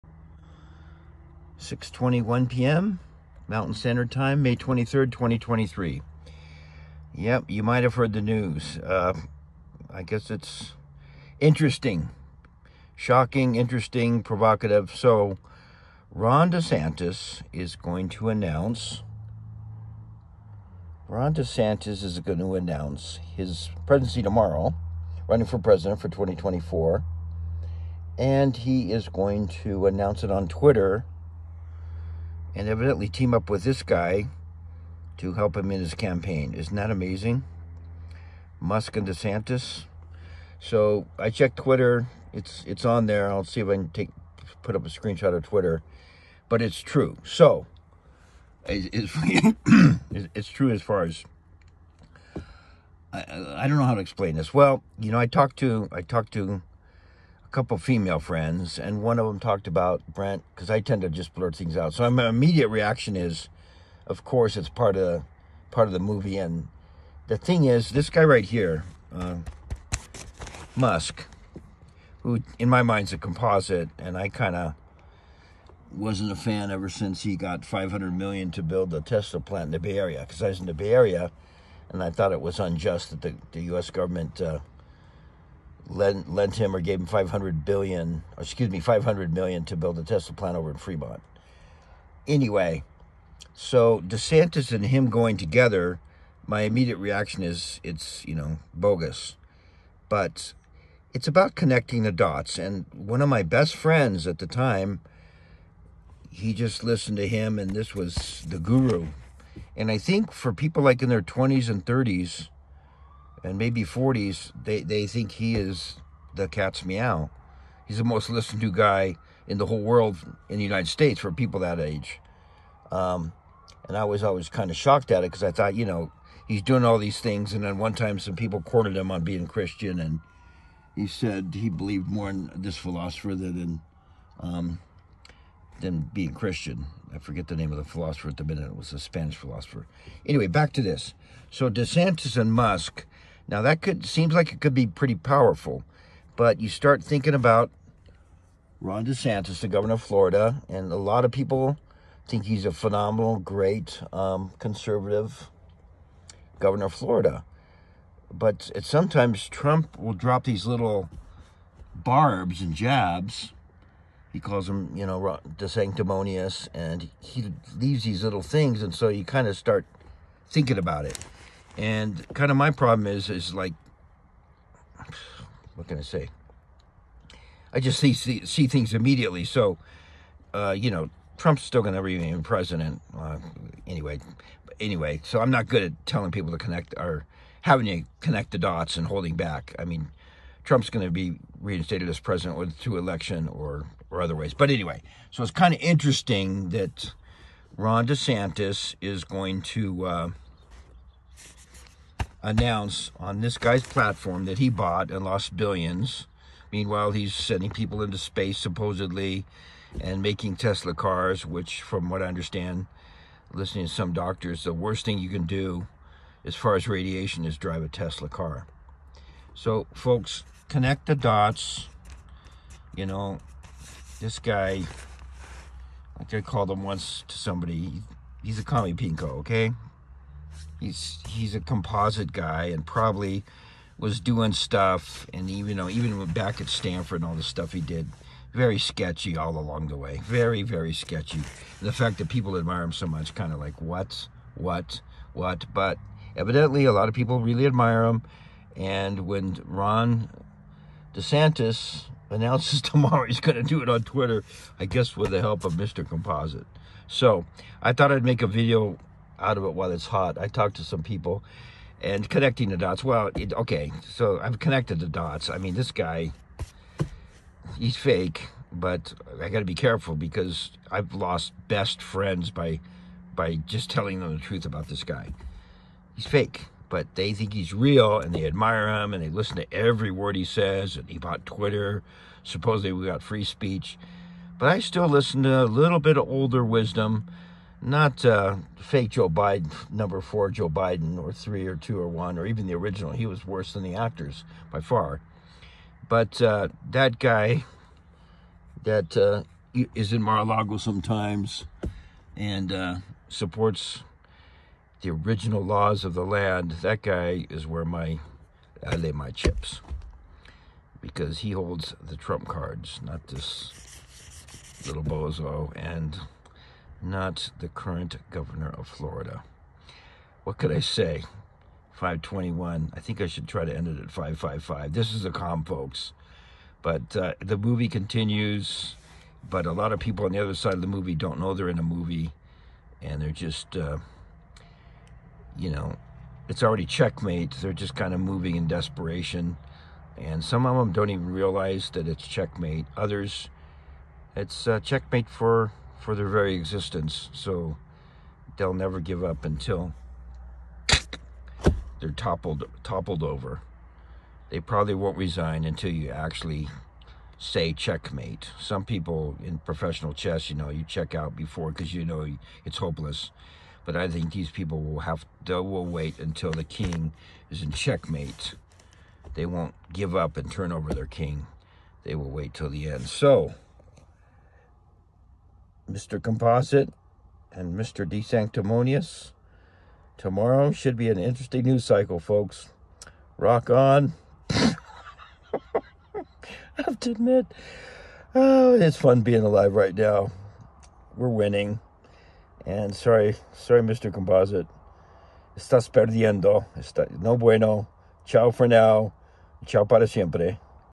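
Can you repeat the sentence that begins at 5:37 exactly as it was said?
They're just kind of moving in desperation.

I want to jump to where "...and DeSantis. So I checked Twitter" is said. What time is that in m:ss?
0:38.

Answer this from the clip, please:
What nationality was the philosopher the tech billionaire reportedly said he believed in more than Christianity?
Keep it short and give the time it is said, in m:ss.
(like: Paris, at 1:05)
Spanish, at 2:18.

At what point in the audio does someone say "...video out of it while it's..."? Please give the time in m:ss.
4:18.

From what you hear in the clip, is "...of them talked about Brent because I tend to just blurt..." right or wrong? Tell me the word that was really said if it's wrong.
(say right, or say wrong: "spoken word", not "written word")
right.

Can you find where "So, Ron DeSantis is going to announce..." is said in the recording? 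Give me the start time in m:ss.
0:14.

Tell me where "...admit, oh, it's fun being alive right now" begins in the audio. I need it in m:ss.
6:27.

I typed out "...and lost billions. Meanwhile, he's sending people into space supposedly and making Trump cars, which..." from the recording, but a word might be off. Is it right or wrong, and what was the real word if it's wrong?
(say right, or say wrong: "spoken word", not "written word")
wrong: "Tesla", not "Trump".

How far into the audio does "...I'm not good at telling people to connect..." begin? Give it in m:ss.
3:05.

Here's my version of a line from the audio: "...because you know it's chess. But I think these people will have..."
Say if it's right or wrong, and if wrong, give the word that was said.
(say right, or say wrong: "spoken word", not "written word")
wrong: "hopeless", not "chess".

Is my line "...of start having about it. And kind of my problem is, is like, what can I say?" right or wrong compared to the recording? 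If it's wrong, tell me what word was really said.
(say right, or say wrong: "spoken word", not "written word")
wrong: "thinking", not "having".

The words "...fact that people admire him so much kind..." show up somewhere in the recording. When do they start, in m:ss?
4:01.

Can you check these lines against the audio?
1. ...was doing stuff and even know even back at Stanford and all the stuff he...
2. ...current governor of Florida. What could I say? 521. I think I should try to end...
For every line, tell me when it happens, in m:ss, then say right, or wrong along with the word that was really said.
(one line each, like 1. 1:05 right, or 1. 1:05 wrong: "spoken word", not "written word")
1. 3:53 right
2. 5:17 right.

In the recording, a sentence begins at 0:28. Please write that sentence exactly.
And he is going to announce it on Twitter and evidently team up with this guy to help him in his campaign.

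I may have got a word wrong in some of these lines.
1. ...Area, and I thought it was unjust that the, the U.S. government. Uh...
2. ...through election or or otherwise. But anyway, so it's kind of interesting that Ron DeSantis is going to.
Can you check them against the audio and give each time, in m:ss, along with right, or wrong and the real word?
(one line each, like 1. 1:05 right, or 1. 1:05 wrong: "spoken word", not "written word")
1. 1:20 right
2. 3:12 right.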